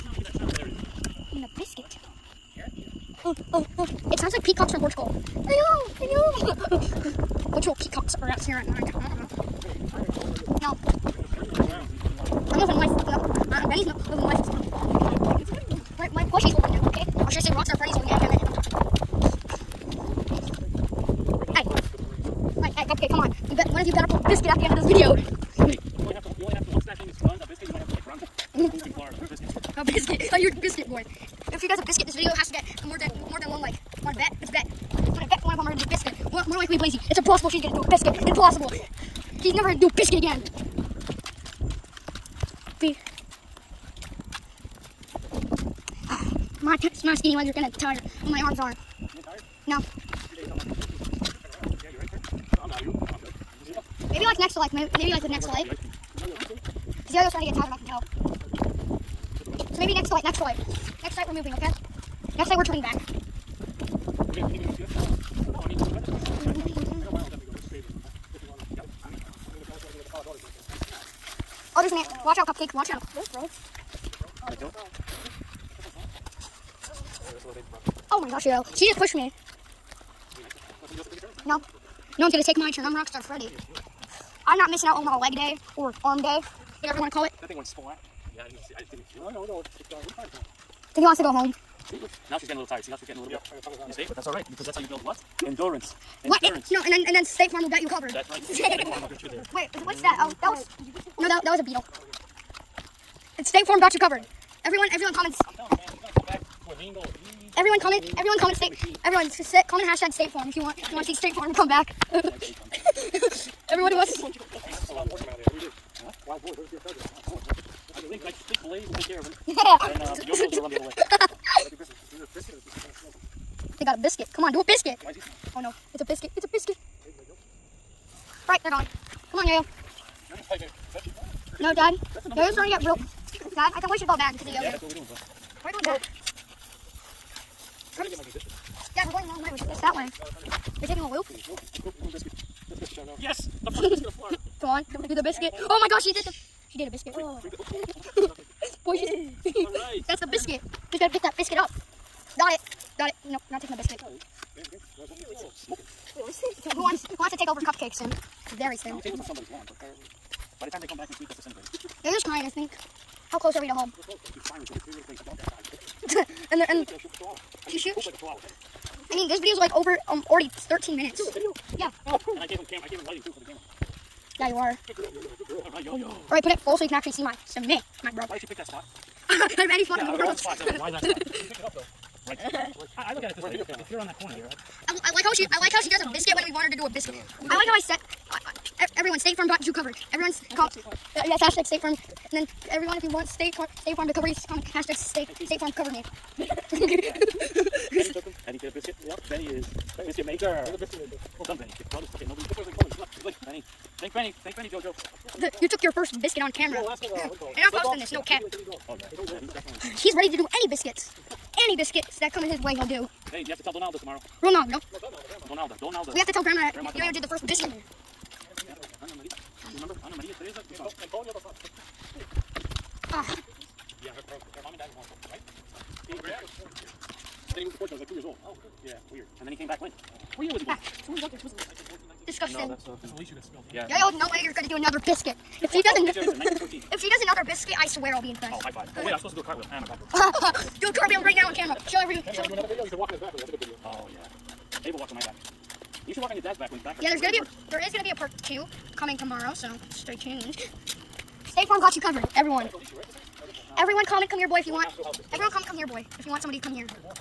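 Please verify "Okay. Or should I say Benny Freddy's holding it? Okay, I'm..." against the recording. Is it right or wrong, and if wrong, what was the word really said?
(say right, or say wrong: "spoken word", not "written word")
wrong: "Rockstar", not "Benny".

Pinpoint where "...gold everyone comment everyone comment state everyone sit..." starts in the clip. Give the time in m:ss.
1:46.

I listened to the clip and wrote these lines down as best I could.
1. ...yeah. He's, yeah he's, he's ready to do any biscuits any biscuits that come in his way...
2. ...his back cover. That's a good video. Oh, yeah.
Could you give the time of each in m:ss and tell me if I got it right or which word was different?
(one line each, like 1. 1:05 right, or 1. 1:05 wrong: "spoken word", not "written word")
1. 3:28 right
2. 4:03 wrong: "later", not "cover".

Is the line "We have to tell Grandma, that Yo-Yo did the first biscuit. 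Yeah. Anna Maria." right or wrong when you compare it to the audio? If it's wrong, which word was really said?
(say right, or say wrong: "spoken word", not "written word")
right.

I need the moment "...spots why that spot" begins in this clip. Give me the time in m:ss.
3:00.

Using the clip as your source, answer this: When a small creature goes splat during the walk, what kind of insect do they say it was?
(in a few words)
beetle.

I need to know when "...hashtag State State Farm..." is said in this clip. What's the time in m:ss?
3:14.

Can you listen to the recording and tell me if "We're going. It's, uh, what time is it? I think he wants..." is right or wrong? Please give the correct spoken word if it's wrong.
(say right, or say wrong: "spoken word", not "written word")
right.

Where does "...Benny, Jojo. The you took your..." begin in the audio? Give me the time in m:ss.
3:24.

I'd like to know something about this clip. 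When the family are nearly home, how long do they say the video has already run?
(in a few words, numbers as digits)
13 minutes.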